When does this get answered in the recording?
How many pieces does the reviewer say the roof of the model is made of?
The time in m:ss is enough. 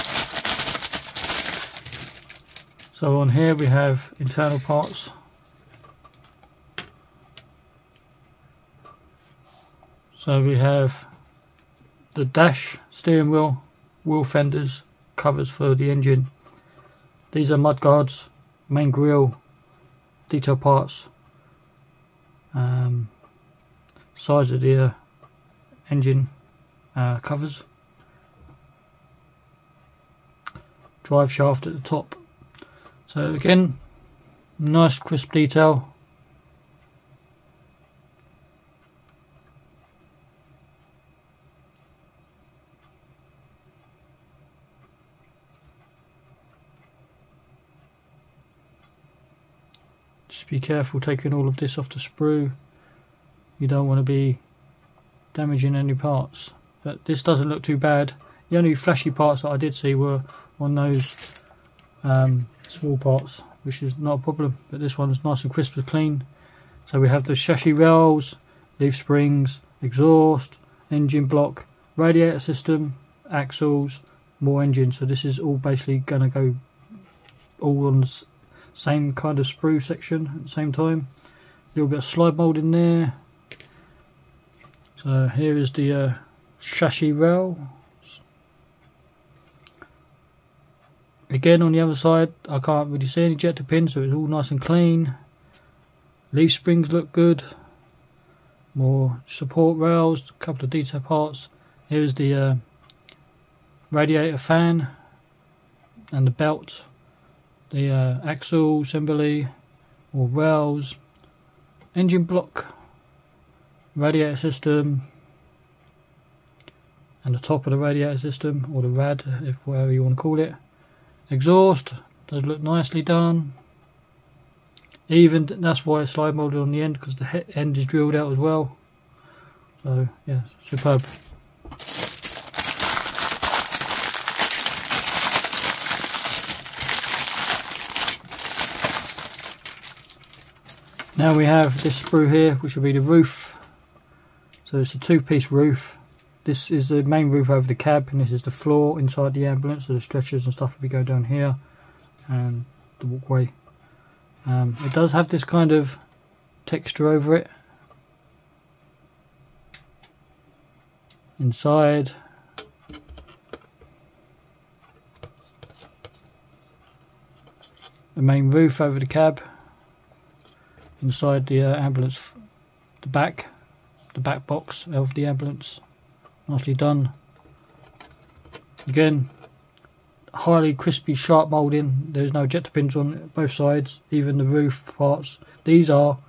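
2:24.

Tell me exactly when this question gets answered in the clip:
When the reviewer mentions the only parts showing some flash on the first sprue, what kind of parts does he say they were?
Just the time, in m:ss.
1:02.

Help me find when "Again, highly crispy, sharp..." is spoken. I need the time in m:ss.
2:58.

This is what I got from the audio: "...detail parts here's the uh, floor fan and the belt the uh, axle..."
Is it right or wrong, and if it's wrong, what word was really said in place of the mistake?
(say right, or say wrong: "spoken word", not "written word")
wrong: "radiator", not "floor".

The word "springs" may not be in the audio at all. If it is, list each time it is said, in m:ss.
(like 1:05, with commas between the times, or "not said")
1:08, 1:36.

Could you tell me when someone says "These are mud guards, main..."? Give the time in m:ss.
0:17.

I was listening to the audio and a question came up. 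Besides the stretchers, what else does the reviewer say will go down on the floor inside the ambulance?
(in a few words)
the walkway.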